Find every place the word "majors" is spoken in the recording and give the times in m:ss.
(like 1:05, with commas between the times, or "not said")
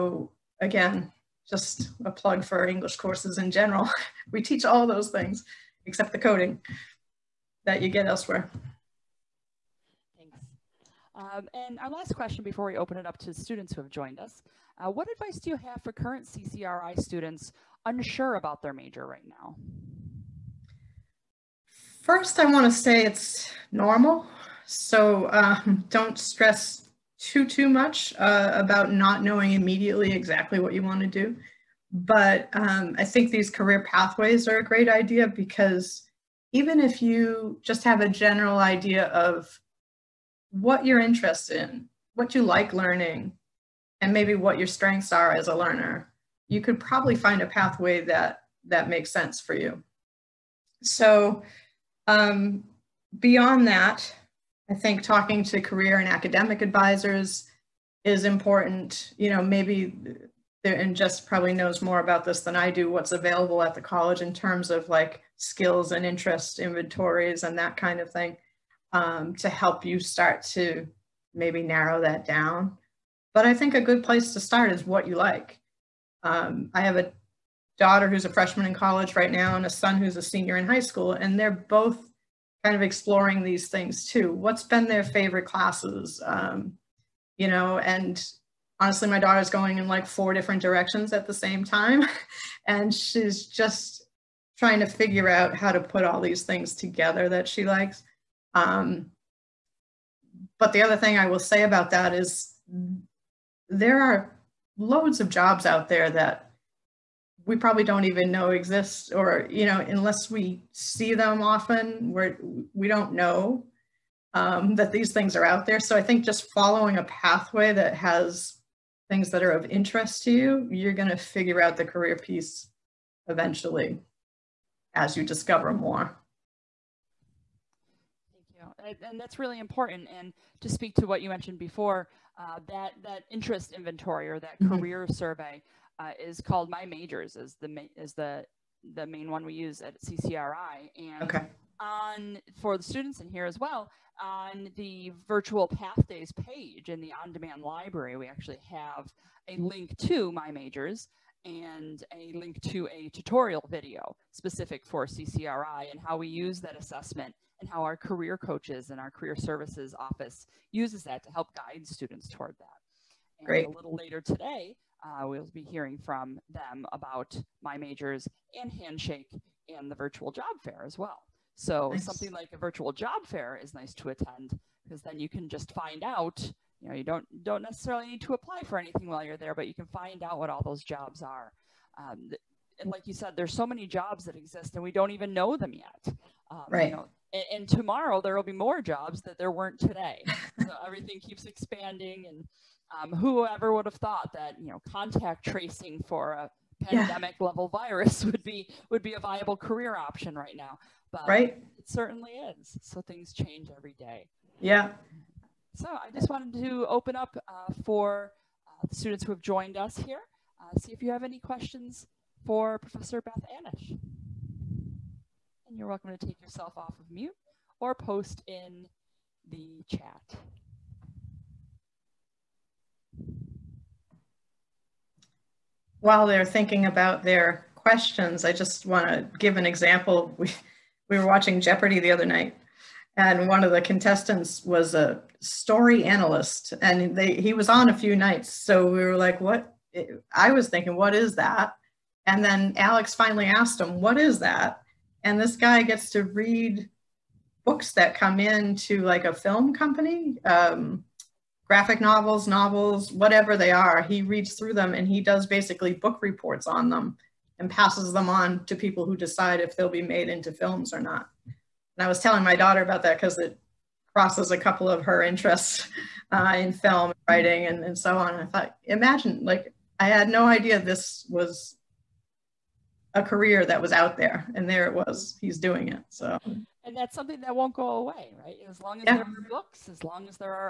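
0:18, 2:16, 2:30, 2:47.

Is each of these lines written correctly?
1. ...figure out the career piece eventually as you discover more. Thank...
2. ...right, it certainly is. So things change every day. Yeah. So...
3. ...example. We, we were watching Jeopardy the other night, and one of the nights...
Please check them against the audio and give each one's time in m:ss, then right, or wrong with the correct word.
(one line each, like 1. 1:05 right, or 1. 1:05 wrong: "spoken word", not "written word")
1. 2:01 right
2. 3:21 right
3. 3:49 wrong: "contestants", not "nights".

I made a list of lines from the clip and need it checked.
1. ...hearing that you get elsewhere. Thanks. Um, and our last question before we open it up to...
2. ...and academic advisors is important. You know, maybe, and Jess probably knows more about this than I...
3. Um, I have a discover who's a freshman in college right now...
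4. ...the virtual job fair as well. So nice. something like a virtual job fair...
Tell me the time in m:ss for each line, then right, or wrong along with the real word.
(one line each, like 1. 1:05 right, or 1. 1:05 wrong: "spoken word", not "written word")
1. 0:06 wrong: "coding", not "hearing"
2. 0:55 right
3. 1:16 wrong: "daughter", not "discover"
4. 2:49 right.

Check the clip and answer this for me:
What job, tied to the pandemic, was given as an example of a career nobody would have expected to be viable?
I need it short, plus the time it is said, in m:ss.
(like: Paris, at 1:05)
Contact tracing, at 3:14.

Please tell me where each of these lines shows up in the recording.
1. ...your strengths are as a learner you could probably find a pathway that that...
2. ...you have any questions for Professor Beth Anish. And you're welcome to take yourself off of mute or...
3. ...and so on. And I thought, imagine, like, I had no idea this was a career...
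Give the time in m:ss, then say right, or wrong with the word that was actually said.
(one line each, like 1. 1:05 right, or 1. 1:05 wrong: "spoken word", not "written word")
1. 0:44 right
2. 3:31 right
3. 4:27 right.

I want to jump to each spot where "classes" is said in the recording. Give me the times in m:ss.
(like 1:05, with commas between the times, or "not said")
1:25.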